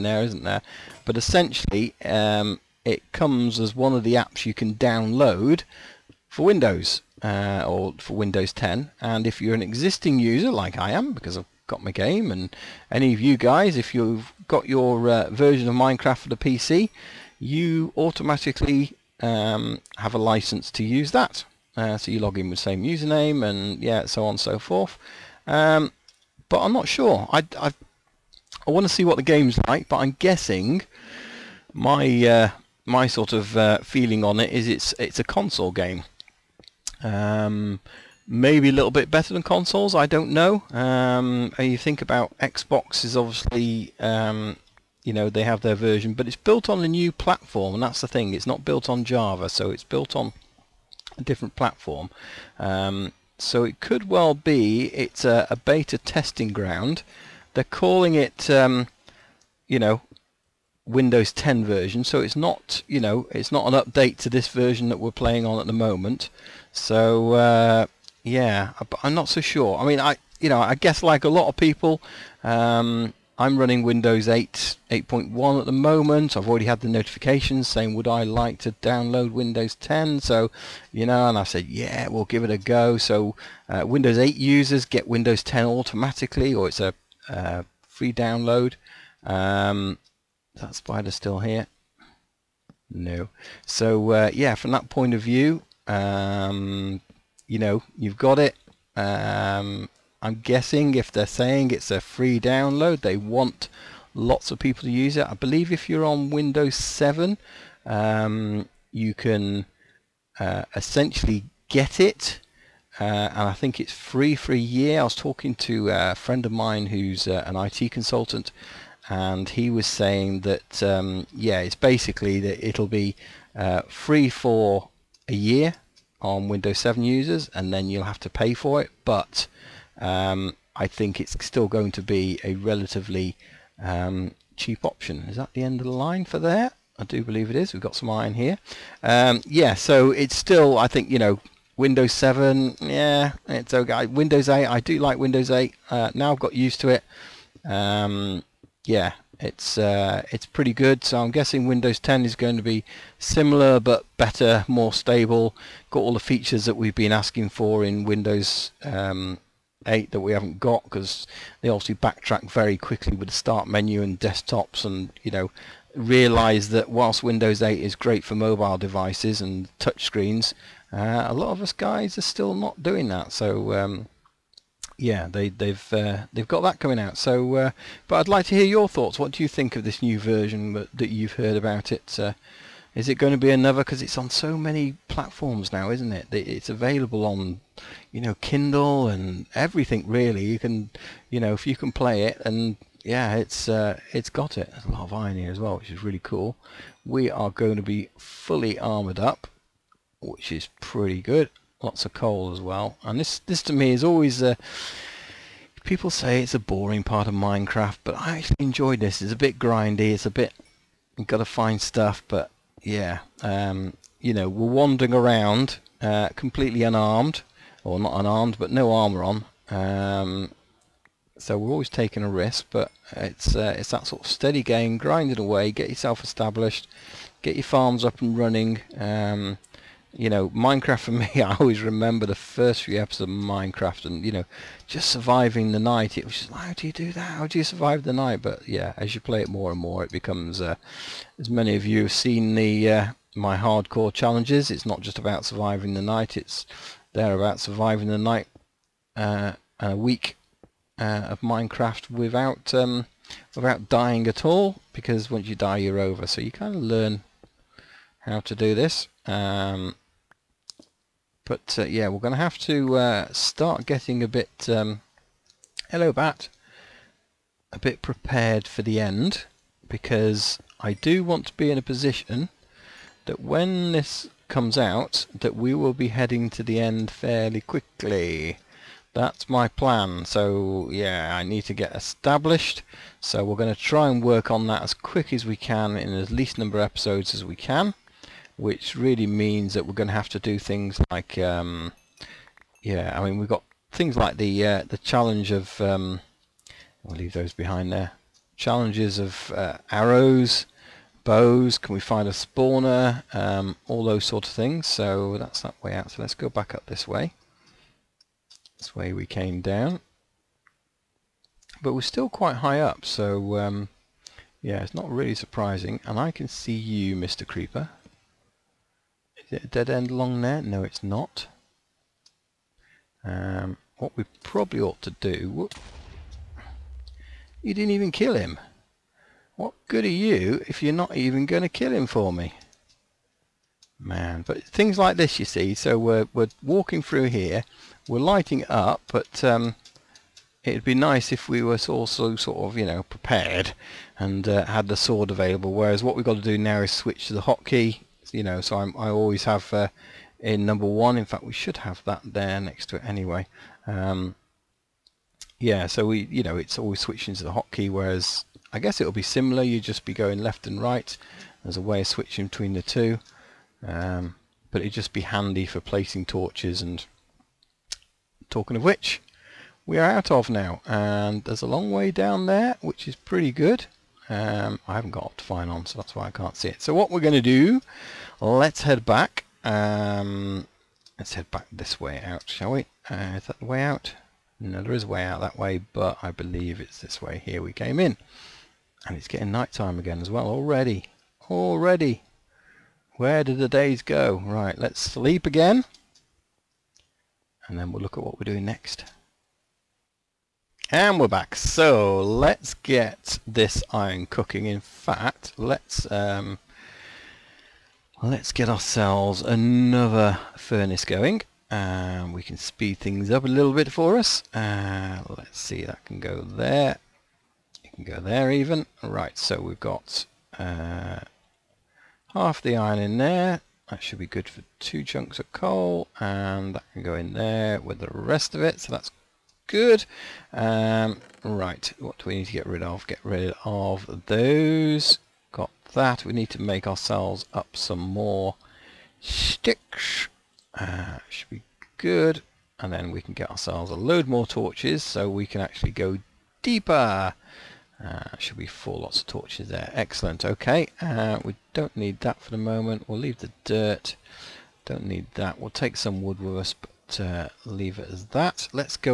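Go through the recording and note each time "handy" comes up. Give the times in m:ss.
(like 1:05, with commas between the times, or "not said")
6:05.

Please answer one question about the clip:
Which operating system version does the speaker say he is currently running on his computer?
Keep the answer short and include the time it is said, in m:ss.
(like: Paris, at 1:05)
Windows 8.1, at 1:14.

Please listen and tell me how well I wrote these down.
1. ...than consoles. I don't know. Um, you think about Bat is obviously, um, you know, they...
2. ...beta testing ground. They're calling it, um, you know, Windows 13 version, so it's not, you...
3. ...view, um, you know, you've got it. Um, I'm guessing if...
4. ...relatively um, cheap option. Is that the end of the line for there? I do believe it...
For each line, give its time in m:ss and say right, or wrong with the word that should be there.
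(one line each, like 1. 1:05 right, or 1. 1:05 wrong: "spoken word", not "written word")
1. 0:39 wrong: "Xbox", not "Bat"
2. 0:55 wrong: "10", not "13"
3. 1:35 right
4. 2:12 right.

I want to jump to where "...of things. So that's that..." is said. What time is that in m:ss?
5:04.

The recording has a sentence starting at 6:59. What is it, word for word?
Right, so we've got uh, half the iron in there.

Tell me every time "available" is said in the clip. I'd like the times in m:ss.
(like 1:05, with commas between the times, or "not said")
3:06, 5:45.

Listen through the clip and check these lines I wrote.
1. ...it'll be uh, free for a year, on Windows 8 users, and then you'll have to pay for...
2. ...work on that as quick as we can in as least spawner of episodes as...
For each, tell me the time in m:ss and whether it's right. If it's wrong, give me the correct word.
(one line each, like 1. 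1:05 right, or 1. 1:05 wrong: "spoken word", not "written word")
1. 2:02 wrong: "7", not "8"
2. 4:44 wrong: "number", not "spawner".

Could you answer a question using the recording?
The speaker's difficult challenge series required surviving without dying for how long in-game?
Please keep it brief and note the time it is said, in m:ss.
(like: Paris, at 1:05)
a week, at 4:09.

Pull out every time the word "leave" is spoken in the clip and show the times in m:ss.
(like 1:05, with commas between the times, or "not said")
4:57, 7:33, 7:37.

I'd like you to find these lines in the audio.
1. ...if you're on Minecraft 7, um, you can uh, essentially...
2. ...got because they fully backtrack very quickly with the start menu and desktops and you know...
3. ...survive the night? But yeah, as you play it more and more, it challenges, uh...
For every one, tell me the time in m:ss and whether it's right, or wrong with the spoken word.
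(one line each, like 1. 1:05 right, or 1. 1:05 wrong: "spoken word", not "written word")
1. 1:45 wrong: "Windows", not "Minecraft"
2. 2:40 wrong: "obviously", not "fully"
3. 3:57 wrong: "becomes", not "challenges".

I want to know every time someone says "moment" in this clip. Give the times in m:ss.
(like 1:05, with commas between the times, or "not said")
1:05, 1:15, 7:32.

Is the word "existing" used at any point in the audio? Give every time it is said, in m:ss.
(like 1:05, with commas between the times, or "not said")
0:09.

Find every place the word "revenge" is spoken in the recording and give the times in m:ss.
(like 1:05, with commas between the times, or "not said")
not said.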